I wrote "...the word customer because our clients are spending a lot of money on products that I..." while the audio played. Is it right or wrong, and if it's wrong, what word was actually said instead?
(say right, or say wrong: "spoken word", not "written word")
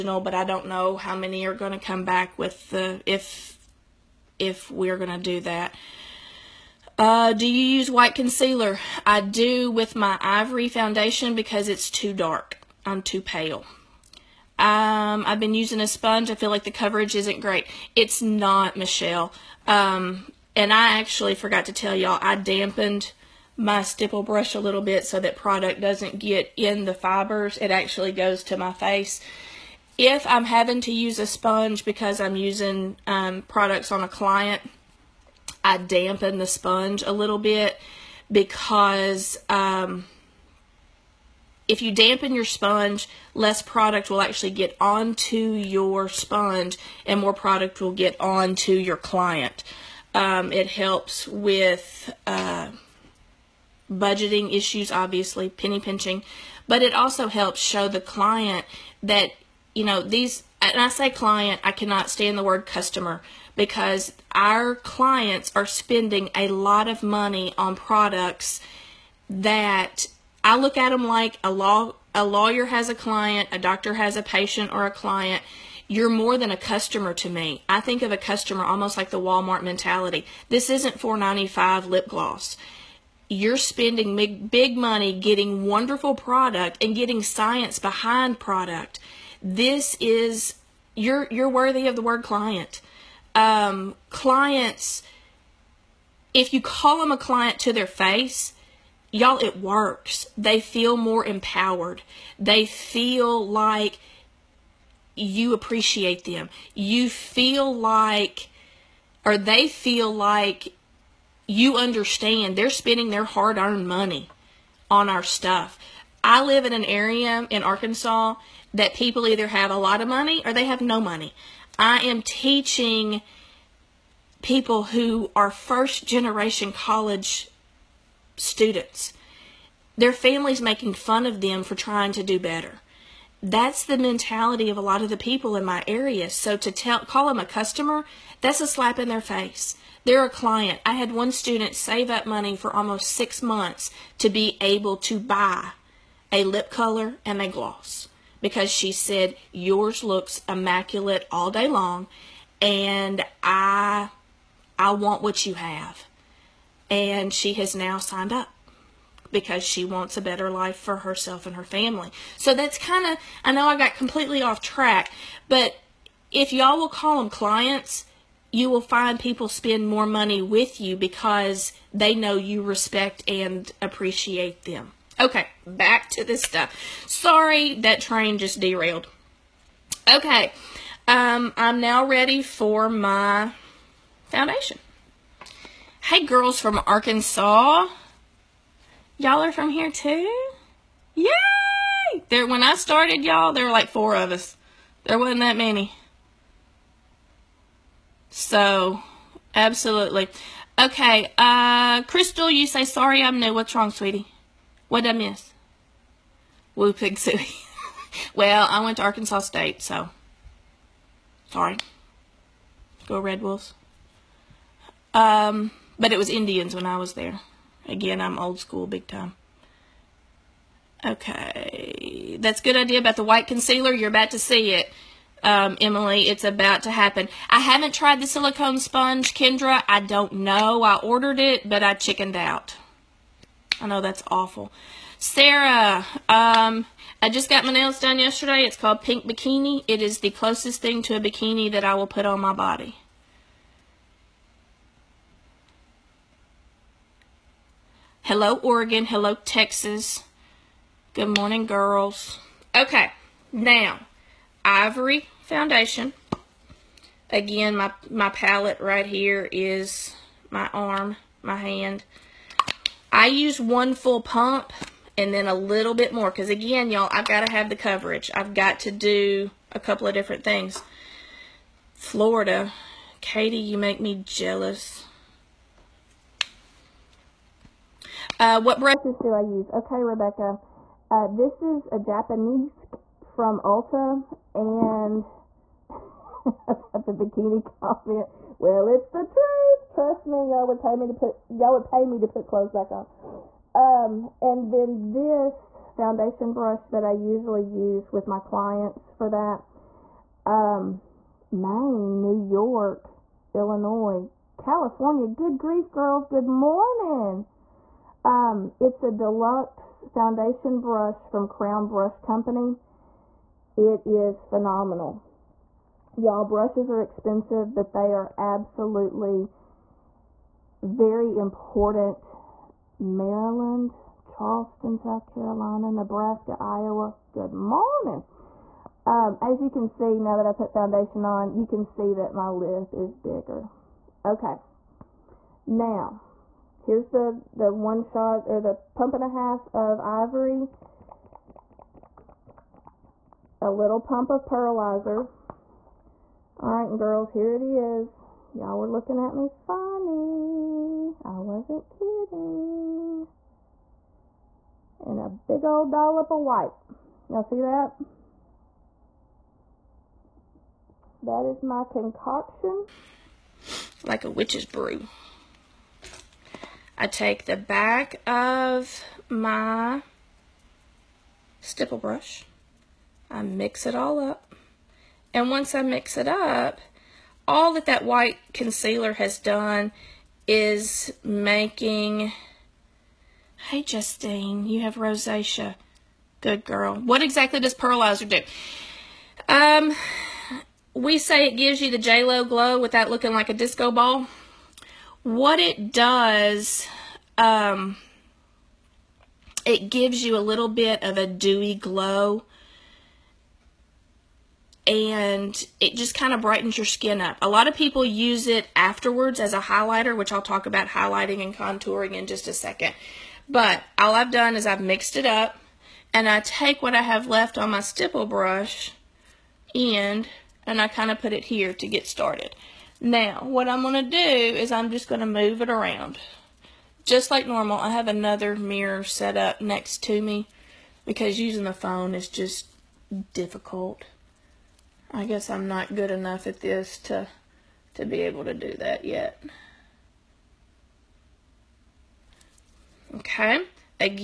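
right.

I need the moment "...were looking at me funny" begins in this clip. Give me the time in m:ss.
5:48.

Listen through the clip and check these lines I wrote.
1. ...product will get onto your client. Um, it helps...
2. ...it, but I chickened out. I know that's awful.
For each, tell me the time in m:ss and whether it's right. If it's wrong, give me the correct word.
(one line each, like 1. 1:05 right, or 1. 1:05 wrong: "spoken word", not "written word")
1. 0:47 right
2. 3:51 right.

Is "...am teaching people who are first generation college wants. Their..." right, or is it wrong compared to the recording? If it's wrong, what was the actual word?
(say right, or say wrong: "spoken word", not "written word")
wrong: "students", not "wants".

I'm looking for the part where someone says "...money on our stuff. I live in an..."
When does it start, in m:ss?
1:53.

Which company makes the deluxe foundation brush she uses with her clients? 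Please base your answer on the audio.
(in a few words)
Crown Brush Company.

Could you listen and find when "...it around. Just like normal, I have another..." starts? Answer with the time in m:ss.
7:05.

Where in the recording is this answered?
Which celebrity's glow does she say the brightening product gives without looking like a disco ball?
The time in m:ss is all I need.
6:31.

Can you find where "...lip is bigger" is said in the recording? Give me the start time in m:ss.
5:32.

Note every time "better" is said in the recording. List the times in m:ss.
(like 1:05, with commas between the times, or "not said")
2:12, 2:40.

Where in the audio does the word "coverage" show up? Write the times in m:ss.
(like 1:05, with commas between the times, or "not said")
0:16, 4:27.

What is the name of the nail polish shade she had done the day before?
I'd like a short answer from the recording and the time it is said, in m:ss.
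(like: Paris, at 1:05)
Pink Bikini, at 3:59.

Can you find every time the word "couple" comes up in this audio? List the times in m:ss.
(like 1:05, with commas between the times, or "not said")
4:29.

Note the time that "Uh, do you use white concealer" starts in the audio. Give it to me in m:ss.
0:06.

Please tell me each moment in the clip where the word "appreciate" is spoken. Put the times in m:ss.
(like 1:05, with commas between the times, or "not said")
1:45, 2:53.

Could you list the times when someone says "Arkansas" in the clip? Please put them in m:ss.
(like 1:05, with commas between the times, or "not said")
1:57, 3:06, 3:29.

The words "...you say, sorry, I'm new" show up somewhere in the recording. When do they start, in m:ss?
3:22.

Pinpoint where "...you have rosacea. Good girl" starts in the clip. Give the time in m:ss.
6:24.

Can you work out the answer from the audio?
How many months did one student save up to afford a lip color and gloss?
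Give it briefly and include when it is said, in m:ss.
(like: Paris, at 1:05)
6, at 2:23.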